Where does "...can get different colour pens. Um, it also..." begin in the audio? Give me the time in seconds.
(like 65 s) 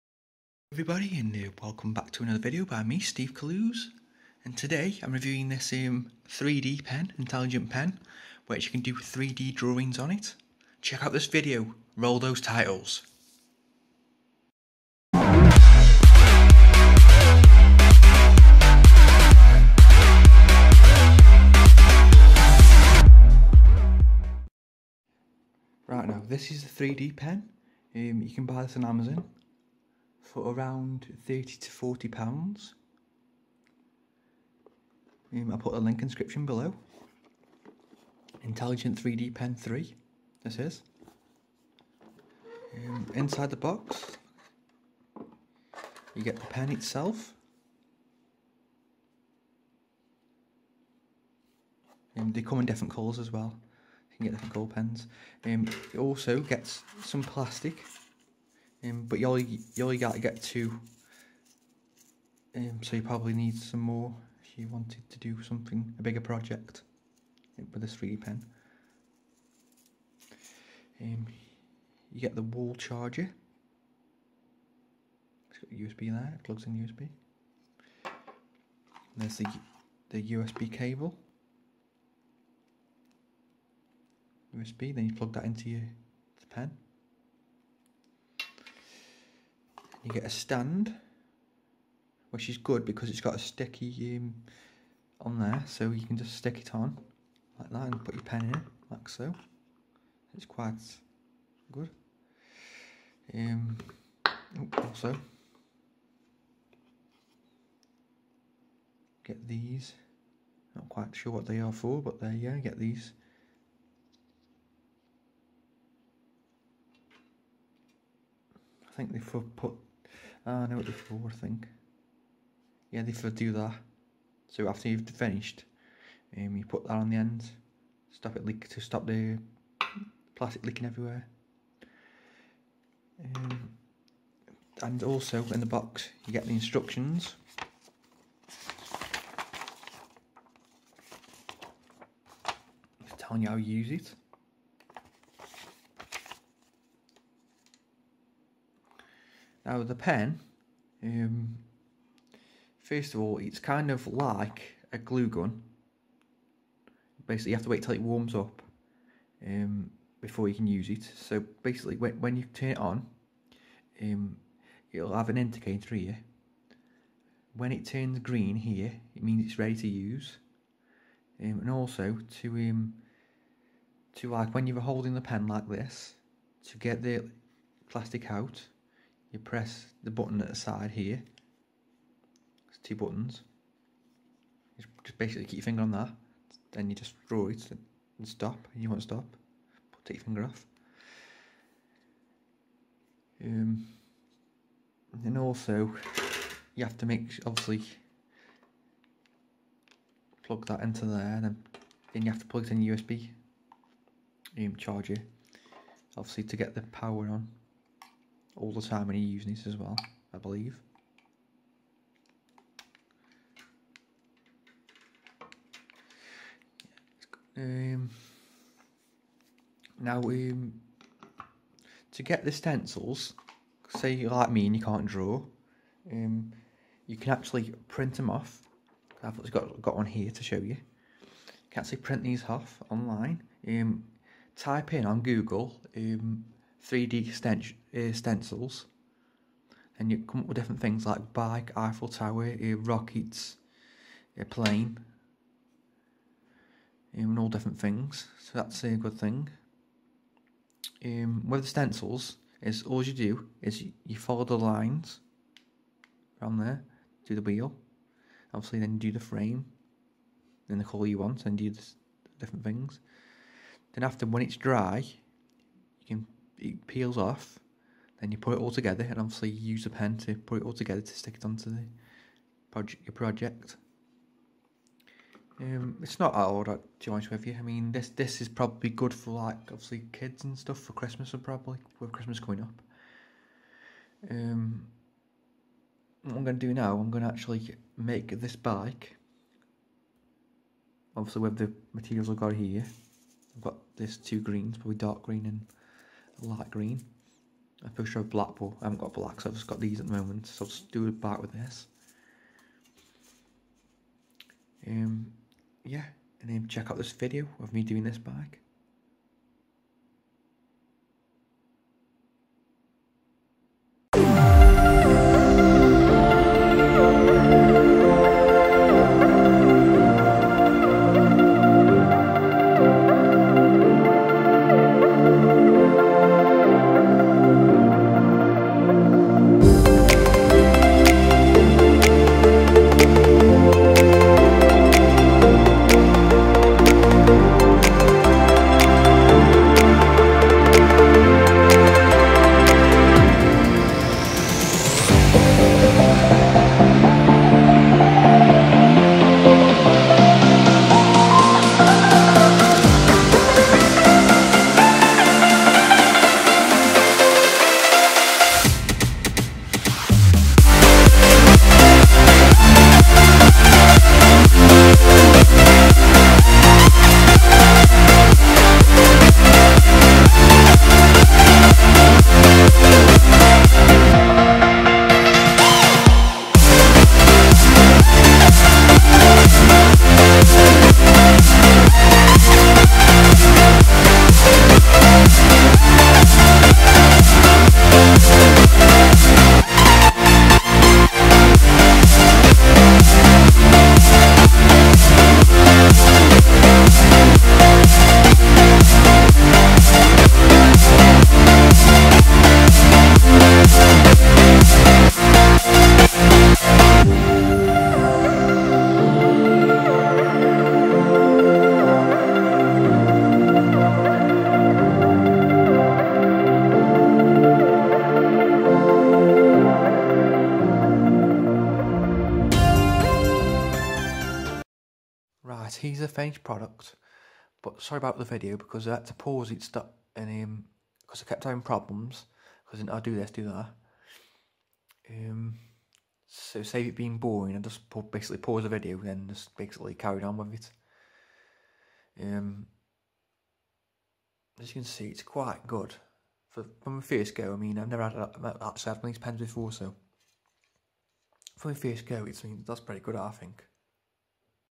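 54 s.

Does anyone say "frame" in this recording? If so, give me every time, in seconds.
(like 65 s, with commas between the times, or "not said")
259 s.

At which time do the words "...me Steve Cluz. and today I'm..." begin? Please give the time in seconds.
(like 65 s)
2 s.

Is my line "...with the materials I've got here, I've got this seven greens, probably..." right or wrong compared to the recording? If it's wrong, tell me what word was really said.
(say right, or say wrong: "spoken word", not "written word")
wrong: "two", not "seven".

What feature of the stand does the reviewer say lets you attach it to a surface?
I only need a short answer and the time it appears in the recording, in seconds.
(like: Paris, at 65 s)
sticky, at 93 s.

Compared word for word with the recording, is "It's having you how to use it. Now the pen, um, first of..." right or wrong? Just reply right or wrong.
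wrong.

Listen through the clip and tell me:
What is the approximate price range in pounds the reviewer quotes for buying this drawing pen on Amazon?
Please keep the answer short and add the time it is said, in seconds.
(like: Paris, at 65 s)
30 to 40 pounds, at 31 s.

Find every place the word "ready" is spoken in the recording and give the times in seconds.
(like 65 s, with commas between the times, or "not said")
169 s.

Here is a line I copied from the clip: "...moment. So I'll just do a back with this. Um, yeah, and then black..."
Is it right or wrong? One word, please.
wrong.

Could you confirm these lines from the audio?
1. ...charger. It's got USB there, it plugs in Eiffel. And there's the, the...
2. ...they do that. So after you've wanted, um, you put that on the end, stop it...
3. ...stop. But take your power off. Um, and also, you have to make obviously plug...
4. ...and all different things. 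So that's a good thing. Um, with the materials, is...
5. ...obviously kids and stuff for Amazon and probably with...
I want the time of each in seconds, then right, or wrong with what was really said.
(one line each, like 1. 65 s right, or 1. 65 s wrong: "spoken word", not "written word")
1. 72 s wrong: "USB", not "Eiffel"
2. 123 s wrong: "finished", not "wanted"
3. 189 s wrong: "finger", not "power"
4. 247 s wrong: "stencils", not "materials"
5. 279 s wrong: "Christmas", not "Amazon".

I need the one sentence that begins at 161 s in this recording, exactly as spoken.
So basically, when, when you turn it on, um, it'll have an indicator here.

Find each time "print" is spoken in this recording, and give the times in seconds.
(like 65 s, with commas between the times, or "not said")
227 s, 231 s.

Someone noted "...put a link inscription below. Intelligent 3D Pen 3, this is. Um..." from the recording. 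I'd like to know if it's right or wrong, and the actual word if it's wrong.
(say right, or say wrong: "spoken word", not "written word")
right.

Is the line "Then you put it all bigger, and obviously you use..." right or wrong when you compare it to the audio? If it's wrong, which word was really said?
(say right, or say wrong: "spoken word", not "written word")
wrong: "together", not "bigger".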